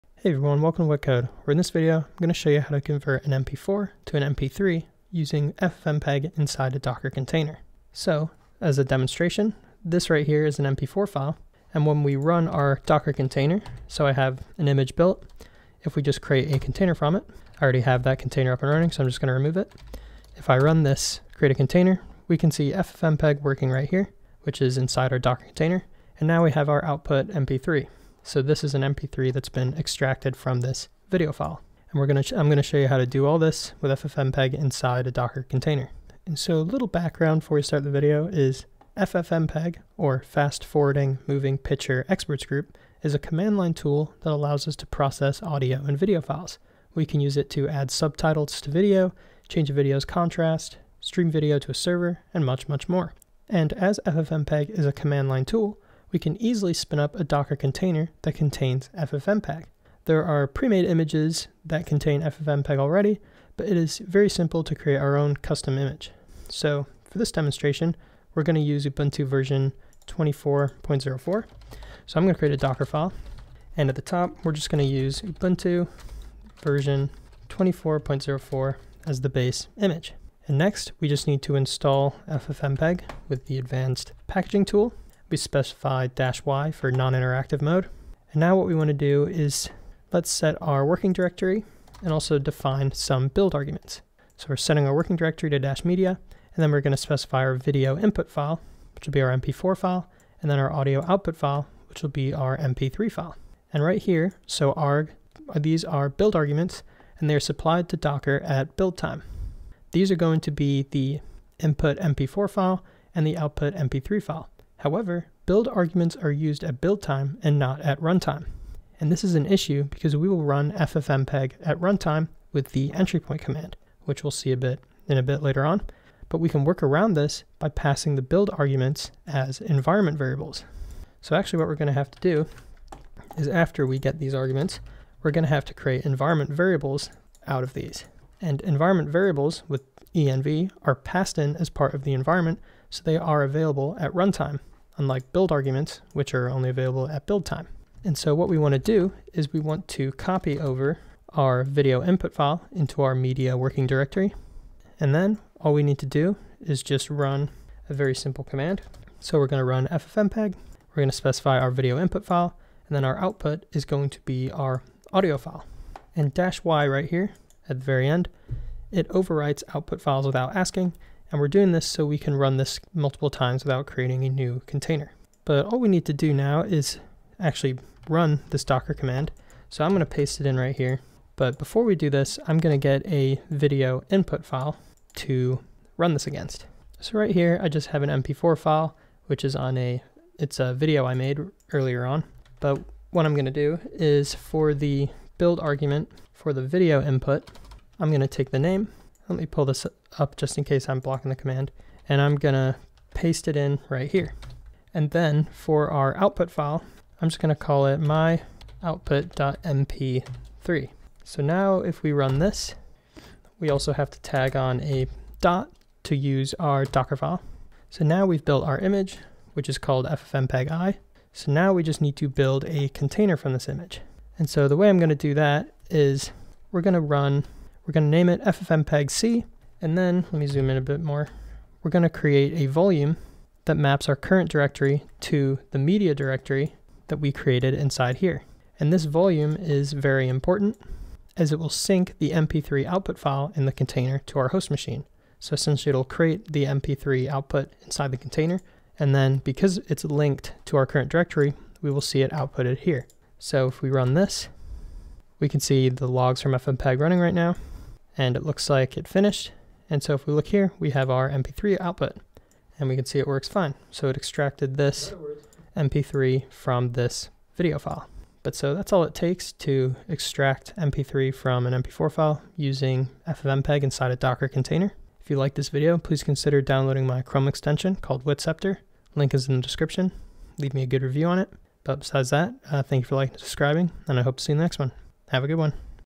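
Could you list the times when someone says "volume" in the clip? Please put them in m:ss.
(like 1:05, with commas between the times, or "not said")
3:52, 3:59.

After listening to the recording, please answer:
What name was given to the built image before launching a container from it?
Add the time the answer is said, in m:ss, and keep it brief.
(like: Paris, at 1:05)
ffmpeg-i, at 3:40.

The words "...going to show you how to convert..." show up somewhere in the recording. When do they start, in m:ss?
0:02.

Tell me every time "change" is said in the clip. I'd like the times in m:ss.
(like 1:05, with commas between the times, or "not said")
0:49.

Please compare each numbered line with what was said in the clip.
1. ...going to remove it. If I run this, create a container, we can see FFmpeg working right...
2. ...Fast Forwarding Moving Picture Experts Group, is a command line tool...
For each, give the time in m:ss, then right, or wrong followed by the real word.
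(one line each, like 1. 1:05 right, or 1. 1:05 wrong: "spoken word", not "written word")
1. 0:19 right
2. 0:40 right.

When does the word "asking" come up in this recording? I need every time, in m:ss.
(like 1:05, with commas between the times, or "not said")
2:50.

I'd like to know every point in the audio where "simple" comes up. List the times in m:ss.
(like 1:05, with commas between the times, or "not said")
1:04, 2:38.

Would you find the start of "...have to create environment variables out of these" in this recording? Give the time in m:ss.
2:15.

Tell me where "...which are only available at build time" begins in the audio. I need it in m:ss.
2:26.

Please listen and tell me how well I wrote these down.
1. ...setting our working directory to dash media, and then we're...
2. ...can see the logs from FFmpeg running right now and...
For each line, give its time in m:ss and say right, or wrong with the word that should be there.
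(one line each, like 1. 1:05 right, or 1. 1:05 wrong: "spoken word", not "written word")
1. 1:34 right
2. 4:15 right.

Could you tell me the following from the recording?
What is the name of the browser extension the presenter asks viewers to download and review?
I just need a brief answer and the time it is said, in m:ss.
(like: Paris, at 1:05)
Witceptor, at 4:38.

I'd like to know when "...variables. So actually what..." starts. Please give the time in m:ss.
2:10.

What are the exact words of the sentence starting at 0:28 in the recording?
So this is an MP3 that's been extracted from this video file.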